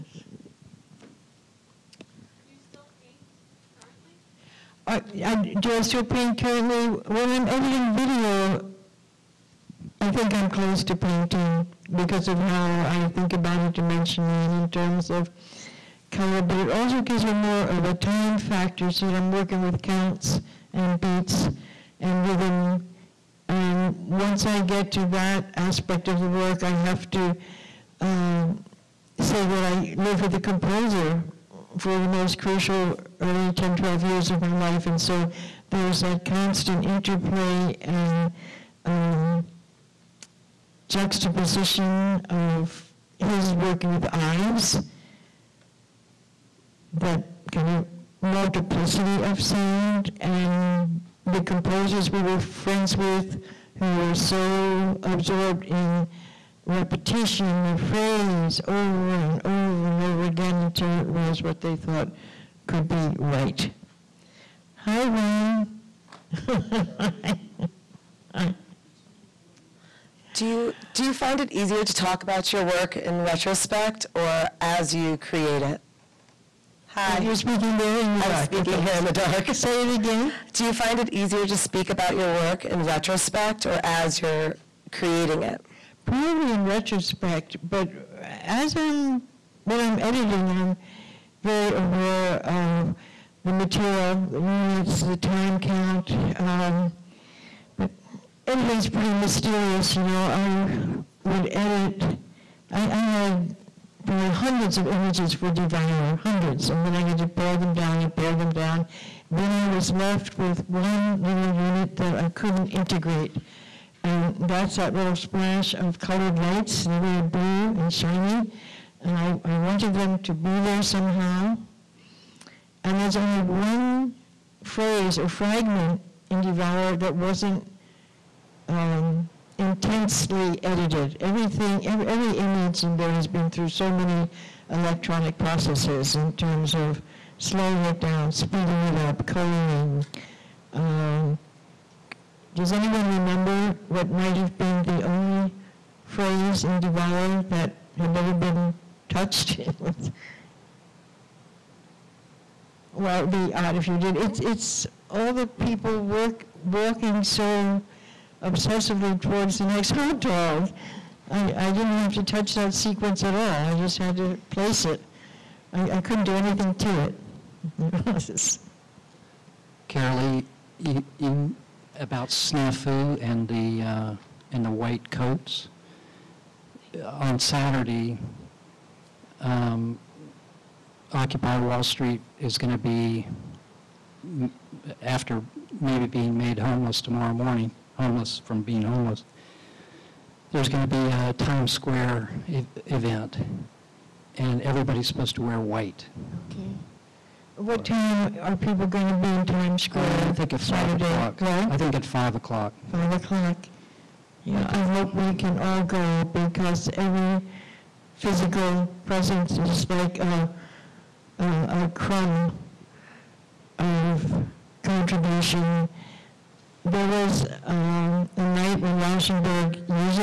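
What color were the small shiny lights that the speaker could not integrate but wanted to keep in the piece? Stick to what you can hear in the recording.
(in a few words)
blue.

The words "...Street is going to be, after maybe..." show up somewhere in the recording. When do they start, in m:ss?
3:01.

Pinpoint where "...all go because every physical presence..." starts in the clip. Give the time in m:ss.
3:25.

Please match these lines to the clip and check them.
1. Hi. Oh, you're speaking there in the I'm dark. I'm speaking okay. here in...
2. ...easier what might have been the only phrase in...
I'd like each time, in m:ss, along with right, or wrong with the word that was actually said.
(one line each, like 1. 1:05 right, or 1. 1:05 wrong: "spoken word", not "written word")
1. 1:16 right
2. 2:23 wrong: "remember", not "easier".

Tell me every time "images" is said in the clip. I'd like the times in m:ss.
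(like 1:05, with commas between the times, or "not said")
1:44, 2:12.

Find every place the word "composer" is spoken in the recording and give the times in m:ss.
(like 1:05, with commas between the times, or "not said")
0:30, 0:51.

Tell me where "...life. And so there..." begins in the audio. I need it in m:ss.
0:34.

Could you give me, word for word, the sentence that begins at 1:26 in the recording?
Probably in retrospect, but as I'm when I'm editing, I'm very aware of the material the units, the time count.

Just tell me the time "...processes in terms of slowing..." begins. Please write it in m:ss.
2:15.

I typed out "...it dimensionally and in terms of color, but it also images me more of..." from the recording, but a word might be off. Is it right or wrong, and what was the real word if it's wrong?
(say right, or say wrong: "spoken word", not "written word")
wrong: "gives", not "images".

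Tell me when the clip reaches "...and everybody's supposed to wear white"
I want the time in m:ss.
3:14.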